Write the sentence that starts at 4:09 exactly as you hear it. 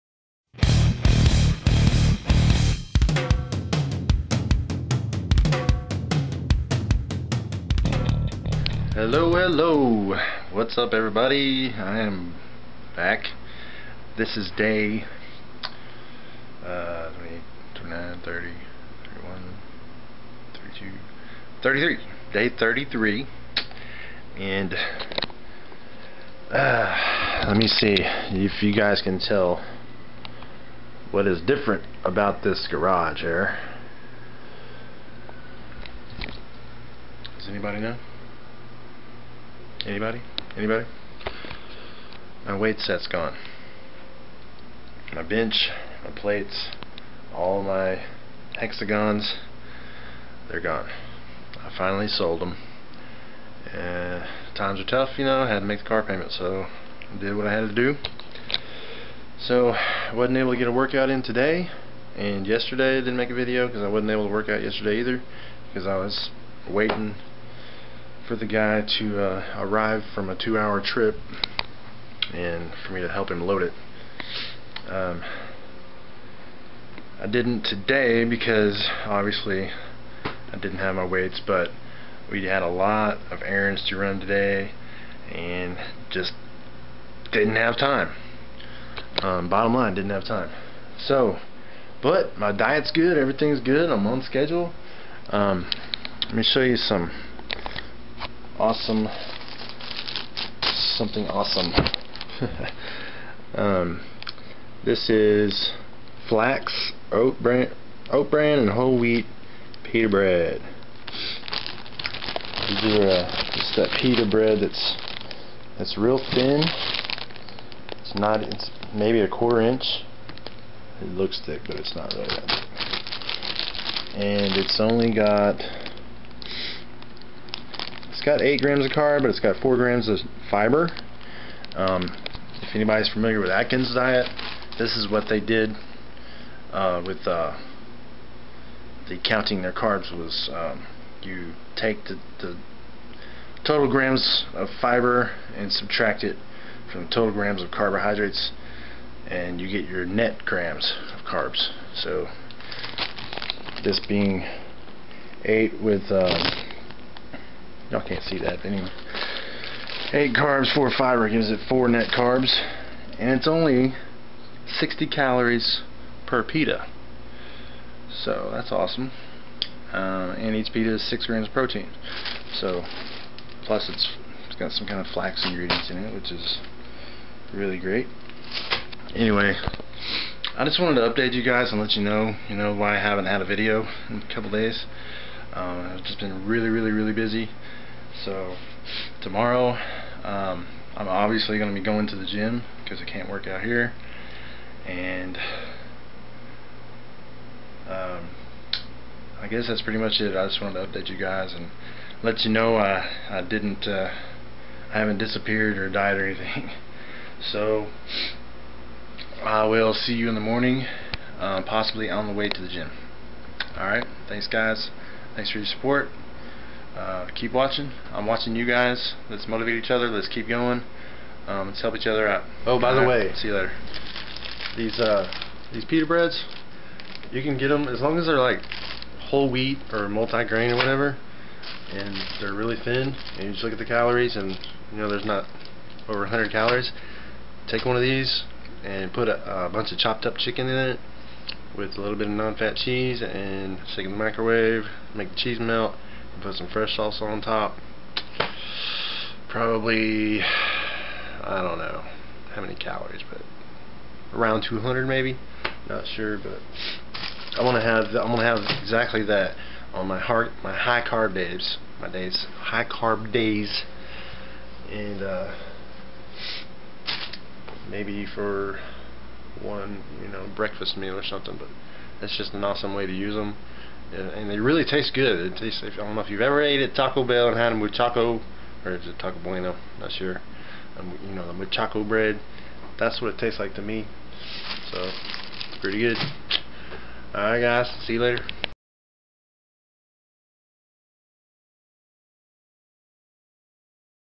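Probably, I don't know how many calories, but around 200 maybe.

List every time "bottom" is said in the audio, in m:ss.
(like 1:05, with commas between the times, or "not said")
1:29.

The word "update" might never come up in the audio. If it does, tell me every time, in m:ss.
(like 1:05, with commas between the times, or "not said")
3:01, 3:20.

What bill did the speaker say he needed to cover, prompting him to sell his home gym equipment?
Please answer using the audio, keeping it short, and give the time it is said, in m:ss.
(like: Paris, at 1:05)
car payment, at 0:55.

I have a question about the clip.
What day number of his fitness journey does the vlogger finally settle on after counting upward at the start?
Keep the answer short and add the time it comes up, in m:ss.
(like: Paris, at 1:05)
Day 33, at 0:22.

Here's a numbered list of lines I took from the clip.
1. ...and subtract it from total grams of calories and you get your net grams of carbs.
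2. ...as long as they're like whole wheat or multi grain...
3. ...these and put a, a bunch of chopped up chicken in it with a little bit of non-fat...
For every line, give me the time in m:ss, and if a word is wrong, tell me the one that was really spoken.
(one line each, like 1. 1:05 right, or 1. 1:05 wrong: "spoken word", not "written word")
1. 2:25 wrong: "carbohydrates", not "calories"
2. 3:47 right
3. 3:58 right.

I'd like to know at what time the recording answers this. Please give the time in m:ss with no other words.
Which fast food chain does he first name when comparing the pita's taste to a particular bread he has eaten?
4:36.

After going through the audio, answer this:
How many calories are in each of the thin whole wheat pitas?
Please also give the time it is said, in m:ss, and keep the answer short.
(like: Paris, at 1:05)
60, at 2:44.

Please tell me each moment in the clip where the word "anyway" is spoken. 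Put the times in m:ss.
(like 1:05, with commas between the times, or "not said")
2:38, 2:59.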